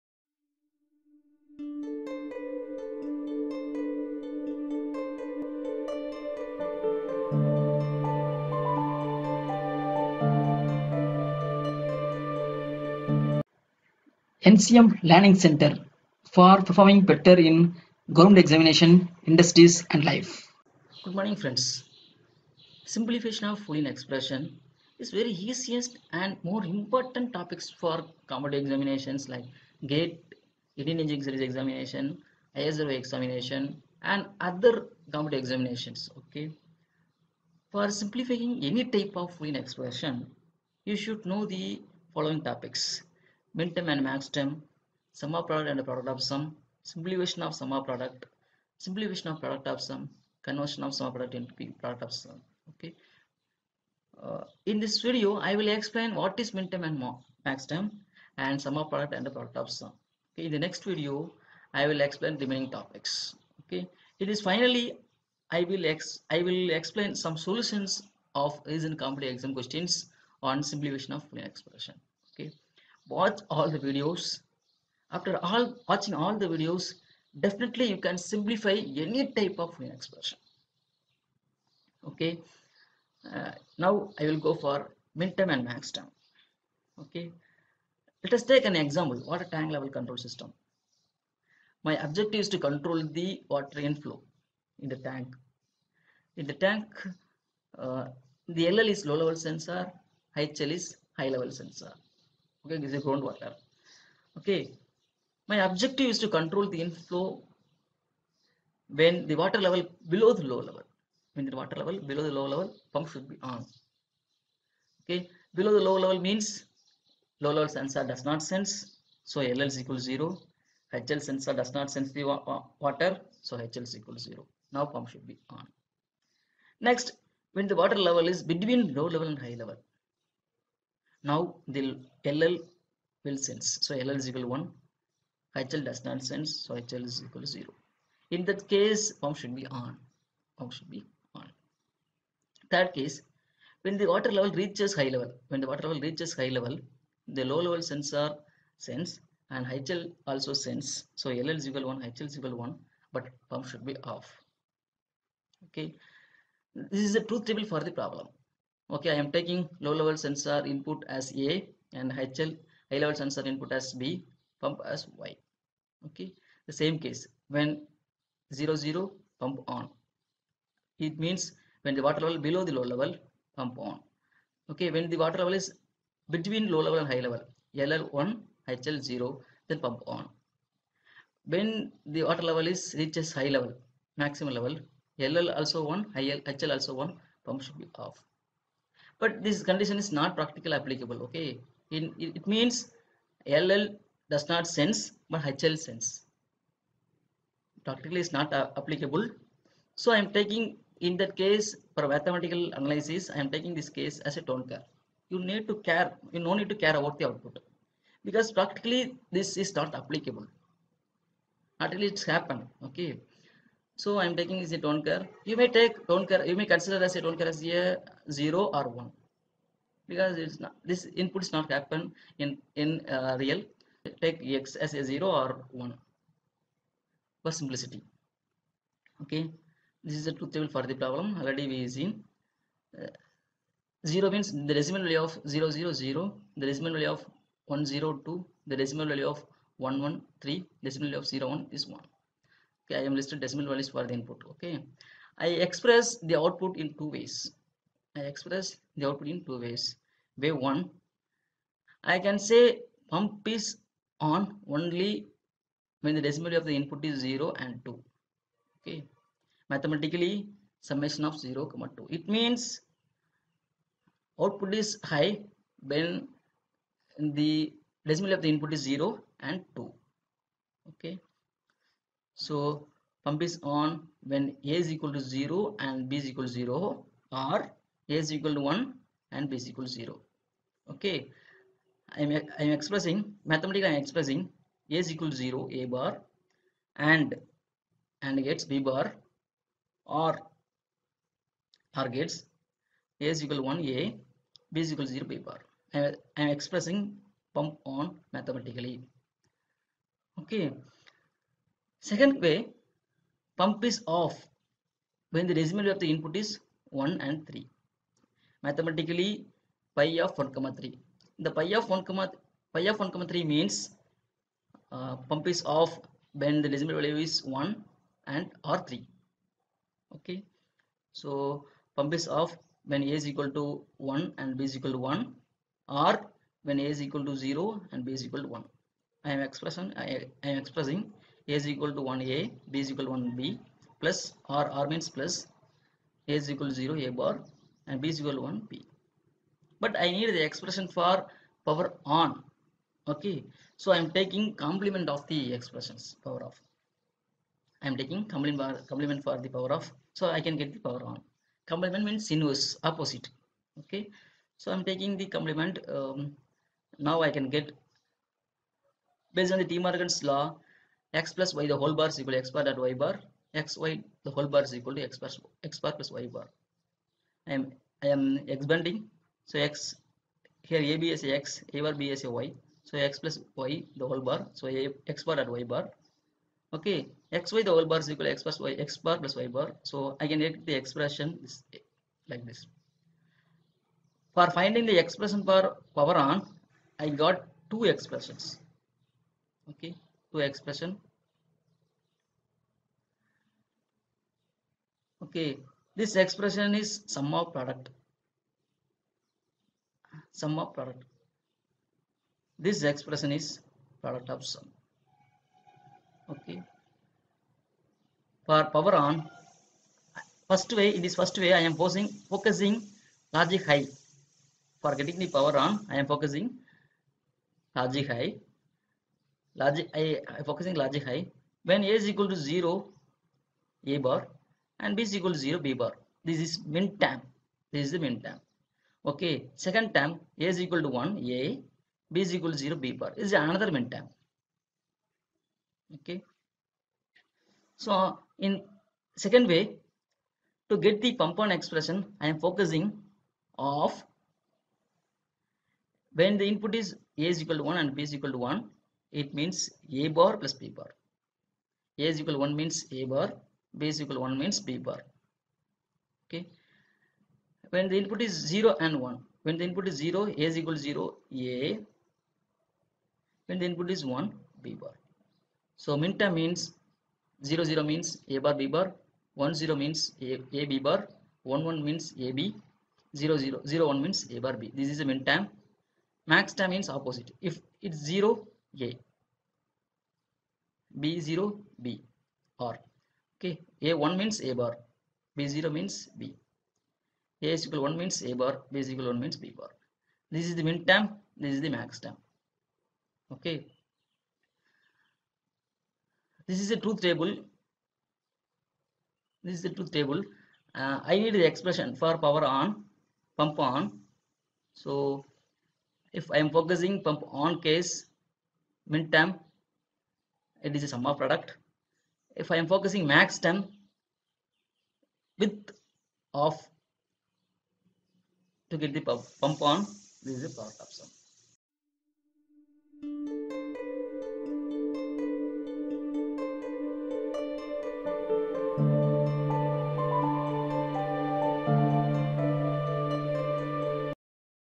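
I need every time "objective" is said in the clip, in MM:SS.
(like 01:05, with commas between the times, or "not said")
01:32, 01:45.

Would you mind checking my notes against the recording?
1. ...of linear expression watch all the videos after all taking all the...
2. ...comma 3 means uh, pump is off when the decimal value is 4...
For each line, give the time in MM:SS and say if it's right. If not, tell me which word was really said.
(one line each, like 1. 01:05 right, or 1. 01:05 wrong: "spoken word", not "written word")
1. 01:11 wrong: "watching", not "taking"
2. 05:13 wrong: "1", not "4".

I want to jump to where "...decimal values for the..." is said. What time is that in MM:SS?
04:03.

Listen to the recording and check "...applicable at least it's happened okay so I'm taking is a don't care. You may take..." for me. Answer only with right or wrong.
right.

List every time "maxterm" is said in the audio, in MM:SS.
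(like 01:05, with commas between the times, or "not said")
00:44, 00:57.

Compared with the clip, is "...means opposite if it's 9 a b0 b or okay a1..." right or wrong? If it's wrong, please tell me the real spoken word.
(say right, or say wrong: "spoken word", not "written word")
wrong: "0", not "9".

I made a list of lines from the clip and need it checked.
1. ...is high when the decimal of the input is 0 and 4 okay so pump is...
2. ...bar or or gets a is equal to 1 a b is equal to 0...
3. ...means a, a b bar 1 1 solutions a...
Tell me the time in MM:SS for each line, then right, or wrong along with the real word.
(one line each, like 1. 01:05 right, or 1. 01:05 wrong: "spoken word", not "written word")
1. 04:24 wrong: "2", not "4"
2. 04:48 right
3. 07:49 wrong: "means", not "solutions".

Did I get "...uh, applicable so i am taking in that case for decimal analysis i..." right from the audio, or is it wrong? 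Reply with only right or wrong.
wrong.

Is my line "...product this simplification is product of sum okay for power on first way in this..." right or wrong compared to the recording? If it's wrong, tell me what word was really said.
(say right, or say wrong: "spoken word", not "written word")
wrong: "expression", not "simplification".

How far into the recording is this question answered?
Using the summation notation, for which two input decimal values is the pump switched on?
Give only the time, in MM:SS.
04:21.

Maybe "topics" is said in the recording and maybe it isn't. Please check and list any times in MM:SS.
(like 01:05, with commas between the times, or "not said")
00:27, 00:42, 01:02.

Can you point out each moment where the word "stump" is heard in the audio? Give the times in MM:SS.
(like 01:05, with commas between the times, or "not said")
not said.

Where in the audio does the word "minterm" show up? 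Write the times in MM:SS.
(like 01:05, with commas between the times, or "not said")
00:43, 00:56.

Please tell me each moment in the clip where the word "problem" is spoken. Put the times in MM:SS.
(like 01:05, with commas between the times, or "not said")
02:38, 03:51.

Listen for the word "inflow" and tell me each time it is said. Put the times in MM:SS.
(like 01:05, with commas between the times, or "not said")
01:33, 01:46.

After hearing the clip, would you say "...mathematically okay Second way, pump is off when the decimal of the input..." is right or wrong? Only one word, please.
right.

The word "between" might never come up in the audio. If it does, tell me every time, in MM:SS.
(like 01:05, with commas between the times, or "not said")
02:08, 02:56.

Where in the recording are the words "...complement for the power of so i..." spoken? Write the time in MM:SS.
05:48.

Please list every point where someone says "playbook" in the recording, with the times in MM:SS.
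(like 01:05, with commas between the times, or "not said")
not said.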